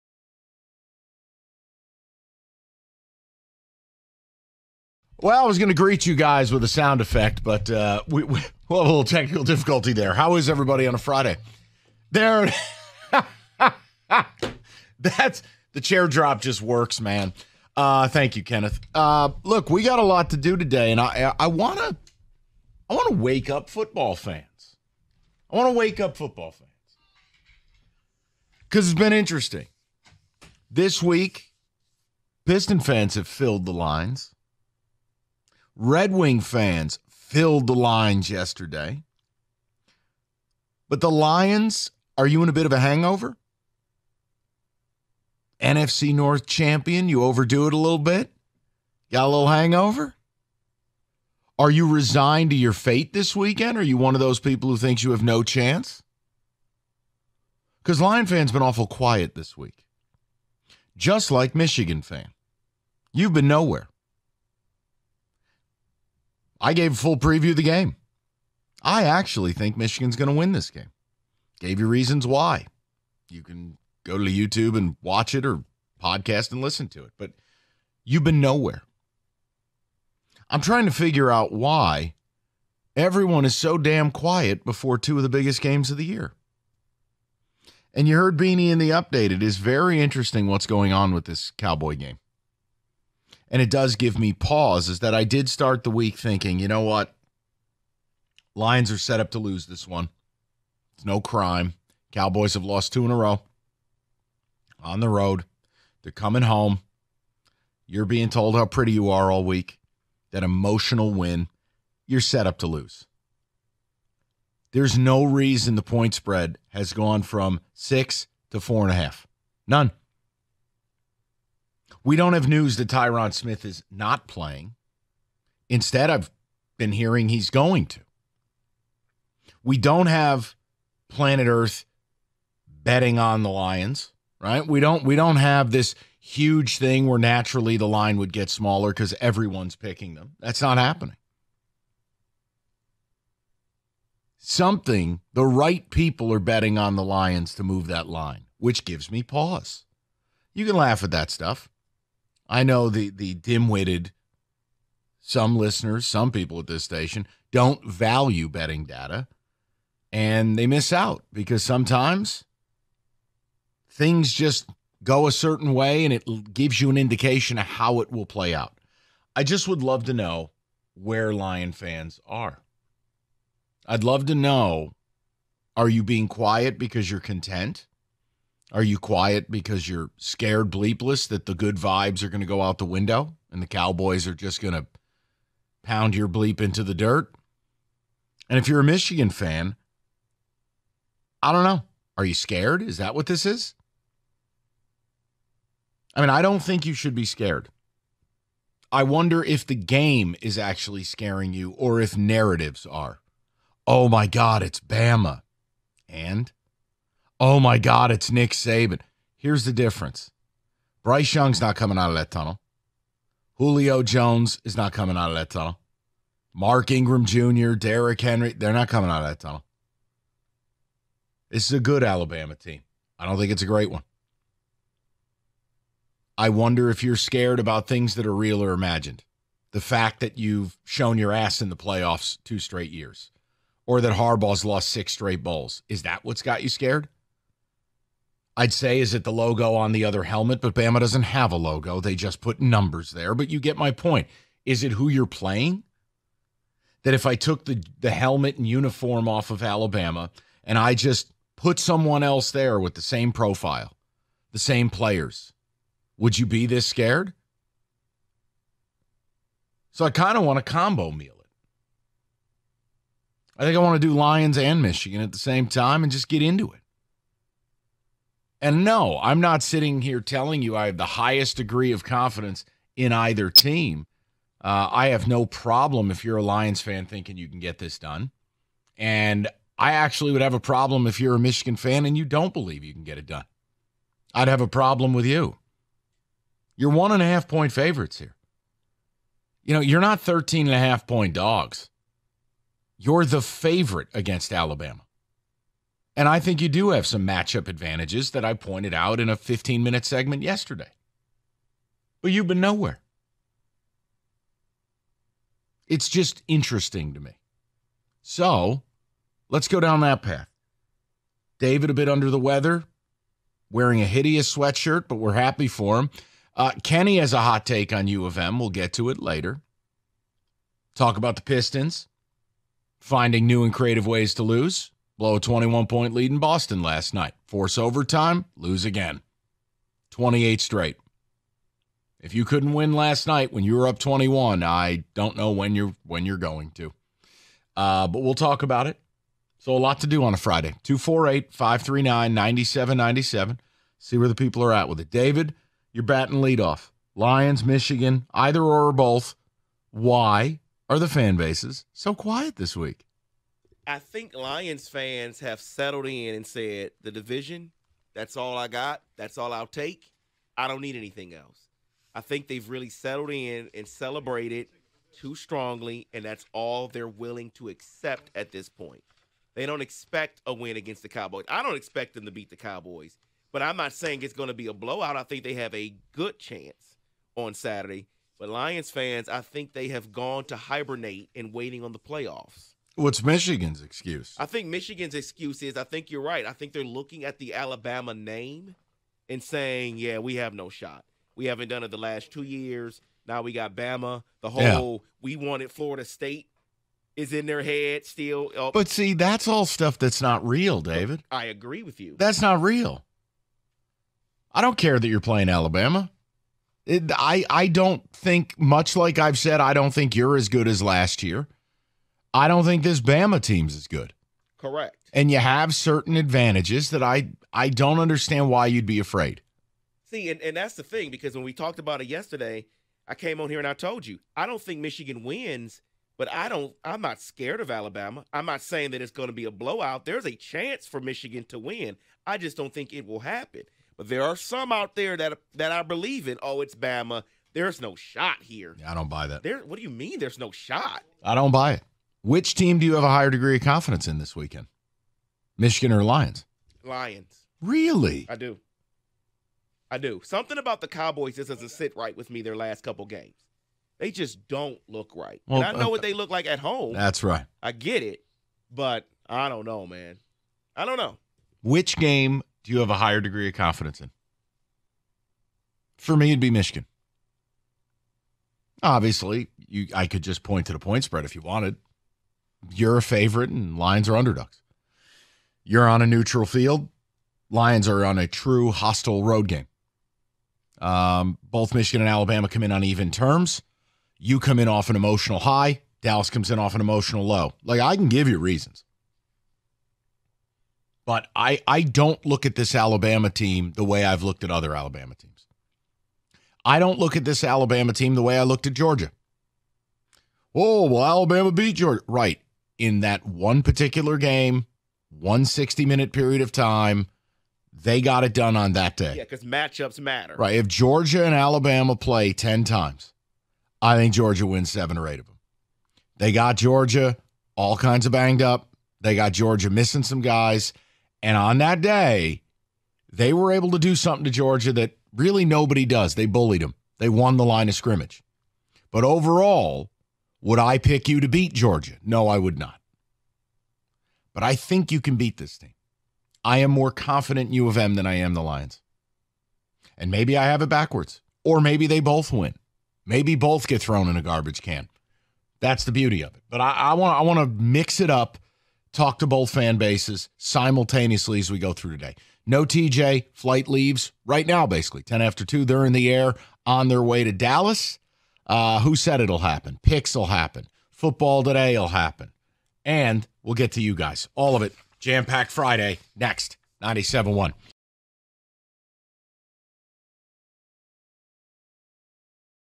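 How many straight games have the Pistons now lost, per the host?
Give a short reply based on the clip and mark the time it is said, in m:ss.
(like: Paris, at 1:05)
28, at 5:30.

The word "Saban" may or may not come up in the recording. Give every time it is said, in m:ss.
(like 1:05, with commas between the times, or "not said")
3:28.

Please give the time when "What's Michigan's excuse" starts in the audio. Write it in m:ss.
6:22.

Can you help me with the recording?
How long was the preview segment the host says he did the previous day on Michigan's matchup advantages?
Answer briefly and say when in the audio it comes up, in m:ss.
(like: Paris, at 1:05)
15 minutes, at 4:59.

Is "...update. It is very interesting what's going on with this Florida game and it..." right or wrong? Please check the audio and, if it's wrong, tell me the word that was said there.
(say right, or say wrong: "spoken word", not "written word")
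wrong: "Cowboy", not "Florida".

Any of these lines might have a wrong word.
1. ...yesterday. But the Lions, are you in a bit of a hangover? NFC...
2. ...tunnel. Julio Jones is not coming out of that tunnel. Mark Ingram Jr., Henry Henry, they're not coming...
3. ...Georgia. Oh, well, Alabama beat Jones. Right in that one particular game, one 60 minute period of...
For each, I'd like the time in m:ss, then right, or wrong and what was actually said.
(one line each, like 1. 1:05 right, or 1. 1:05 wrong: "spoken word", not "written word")
1. 0:38 right
2. 3:32 wrong: "Derrick", not "Henry"
3. 8:18 wrong: "Georgia", not "Jones".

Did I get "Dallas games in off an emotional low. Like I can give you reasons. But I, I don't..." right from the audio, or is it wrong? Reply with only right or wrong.
wrong.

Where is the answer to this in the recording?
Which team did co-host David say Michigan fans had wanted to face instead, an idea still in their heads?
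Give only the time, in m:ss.
6:35.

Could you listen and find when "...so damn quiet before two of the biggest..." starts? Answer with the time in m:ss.
1:23.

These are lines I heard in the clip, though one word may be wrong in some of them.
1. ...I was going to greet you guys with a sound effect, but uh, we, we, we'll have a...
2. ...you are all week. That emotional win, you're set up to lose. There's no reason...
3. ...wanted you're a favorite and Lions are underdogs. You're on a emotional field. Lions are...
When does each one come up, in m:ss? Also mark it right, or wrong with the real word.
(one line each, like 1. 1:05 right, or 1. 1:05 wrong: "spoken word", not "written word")
1. 0:05 right
2. 1:48 right
3. 7:51 wrong: "neutral", not "emotional".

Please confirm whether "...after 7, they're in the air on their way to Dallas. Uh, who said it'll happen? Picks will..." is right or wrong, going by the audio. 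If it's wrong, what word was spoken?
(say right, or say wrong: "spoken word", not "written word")
wrong: "2", not "7".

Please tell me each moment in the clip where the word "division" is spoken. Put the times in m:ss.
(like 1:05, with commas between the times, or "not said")
5:57.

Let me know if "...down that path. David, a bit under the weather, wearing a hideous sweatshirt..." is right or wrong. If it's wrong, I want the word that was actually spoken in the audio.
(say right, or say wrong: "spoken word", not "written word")
right.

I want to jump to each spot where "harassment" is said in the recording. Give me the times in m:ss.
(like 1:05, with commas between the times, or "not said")
not said.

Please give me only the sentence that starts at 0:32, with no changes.
Piston fans have filled the lines.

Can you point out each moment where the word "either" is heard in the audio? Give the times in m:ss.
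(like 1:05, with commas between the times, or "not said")
4:33, 5:48.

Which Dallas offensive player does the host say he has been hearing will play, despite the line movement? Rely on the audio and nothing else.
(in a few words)
Tyron Smith.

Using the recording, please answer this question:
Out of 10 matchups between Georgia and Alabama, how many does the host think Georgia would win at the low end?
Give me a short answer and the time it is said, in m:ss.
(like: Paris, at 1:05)
7, at 8:34.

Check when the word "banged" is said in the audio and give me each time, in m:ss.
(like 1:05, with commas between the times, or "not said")
8:38.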